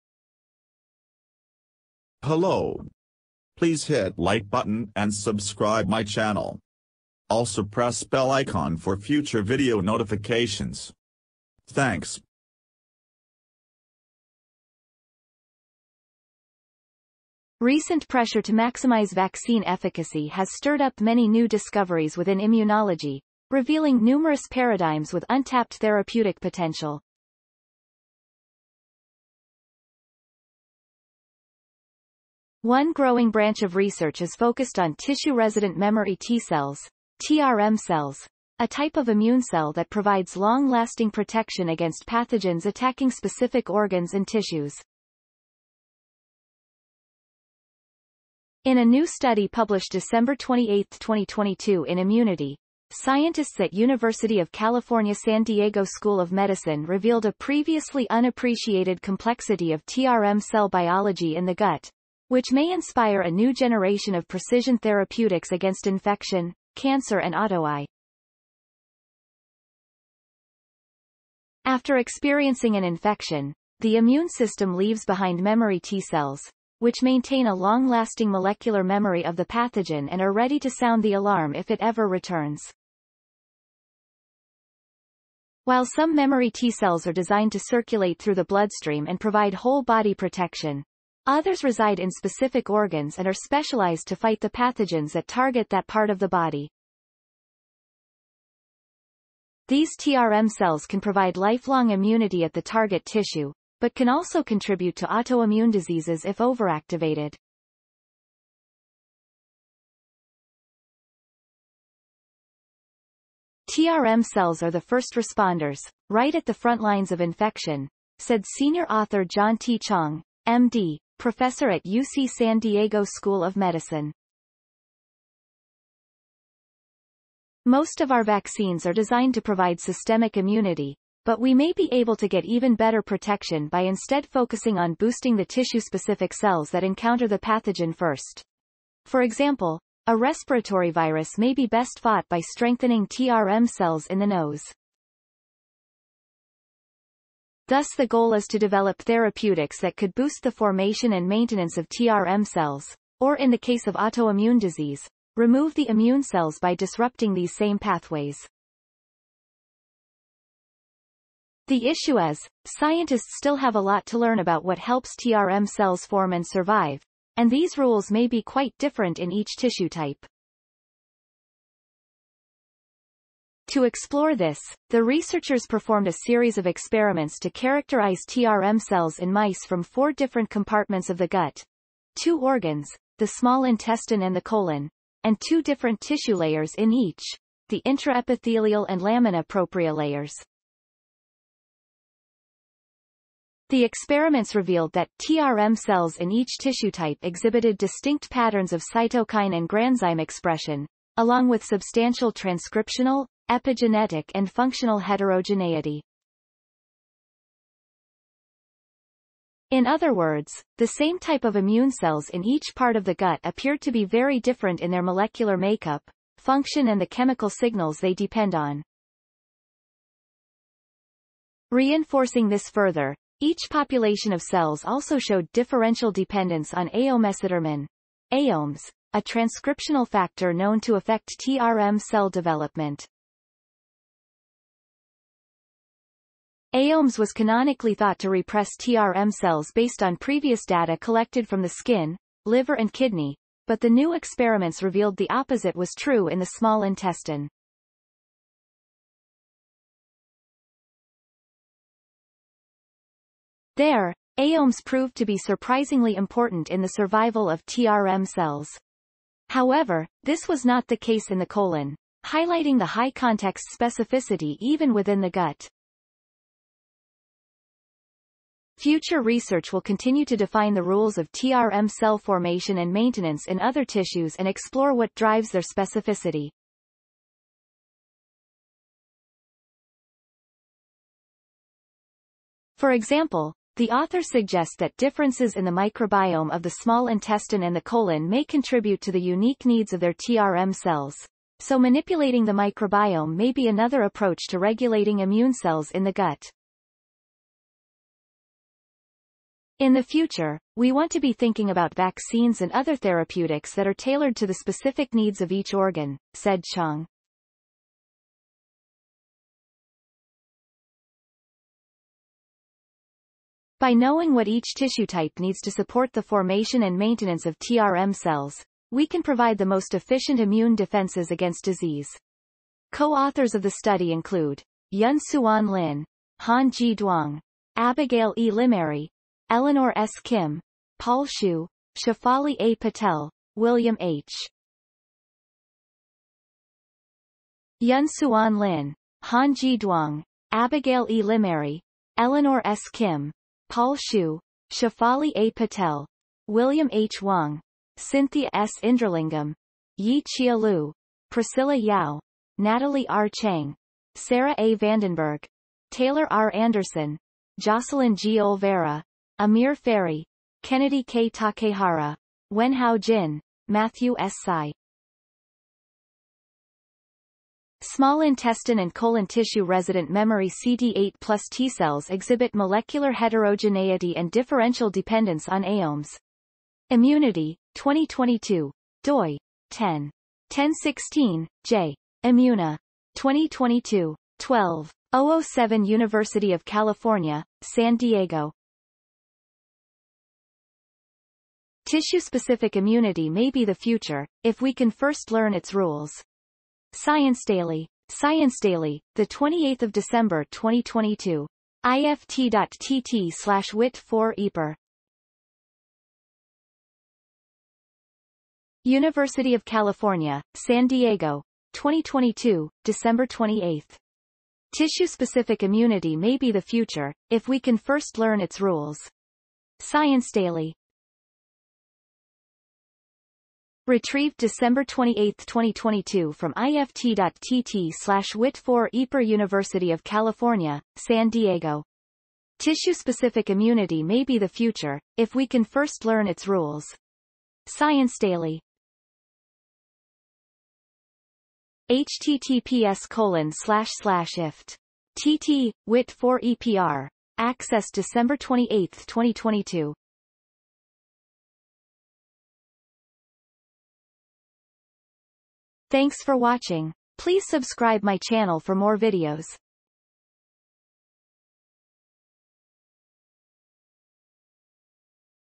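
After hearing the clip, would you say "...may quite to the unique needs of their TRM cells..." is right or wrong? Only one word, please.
wrong.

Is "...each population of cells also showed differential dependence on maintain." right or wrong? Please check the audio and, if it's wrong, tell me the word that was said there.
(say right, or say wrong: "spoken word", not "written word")
wrong: "eomesodermin", not "maintain".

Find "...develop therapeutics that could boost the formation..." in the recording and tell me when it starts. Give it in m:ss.
2:28.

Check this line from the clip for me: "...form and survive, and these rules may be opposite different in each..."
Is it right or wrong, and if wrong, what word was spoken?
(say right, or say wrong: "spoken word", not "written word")
wrong: "quite", not "opposite".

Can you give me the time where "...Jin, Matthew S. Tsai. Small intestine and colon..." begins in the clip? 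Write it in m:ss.
6:03.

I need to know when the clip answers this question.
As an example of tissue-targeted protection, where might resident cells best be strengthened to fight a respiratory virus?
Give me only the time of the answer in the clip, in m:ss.
2:24.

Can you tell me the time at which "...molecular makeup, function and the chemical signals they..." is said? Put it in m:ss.
3:35.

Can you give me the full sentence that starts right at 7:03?
Retrieved December 28, 2022 from ift.tt slash wit4 EPER University of California, San Diego.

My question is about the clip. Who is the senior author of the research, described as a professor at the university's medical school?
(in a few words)
John T. Chang.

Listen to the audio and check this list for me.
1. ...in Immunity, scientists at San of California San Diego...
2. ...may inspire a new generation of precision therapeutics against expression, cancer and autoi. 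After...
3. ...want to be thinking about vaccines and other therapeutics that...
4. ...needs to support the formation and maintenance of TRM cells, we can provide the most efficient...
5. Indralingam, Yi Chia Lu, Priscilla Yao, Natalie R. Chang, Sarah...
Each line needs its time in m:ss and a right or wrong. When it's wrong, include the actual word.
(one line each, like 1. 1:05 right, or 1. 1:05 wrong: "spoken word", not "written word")
1. 0:51 wrong: "University", not "San"
2. 1:02 wrong: "infection", not "expression"
3. 5:00 right
4. 5:15 right
5. 5:48 right.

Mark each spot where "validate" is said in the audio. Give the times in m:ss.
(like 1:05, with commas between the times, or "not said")
not said.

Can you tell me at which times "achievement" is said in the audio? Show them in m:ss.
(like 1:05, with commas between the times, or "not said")
not said.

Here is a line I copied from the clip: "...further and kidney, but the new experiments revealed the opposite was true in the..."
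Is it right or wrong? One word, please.
wrong.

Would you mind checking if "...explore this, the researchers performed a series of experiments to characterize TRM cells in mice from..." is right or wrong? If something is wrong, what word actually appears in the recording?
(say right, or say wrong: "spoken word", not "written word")
right.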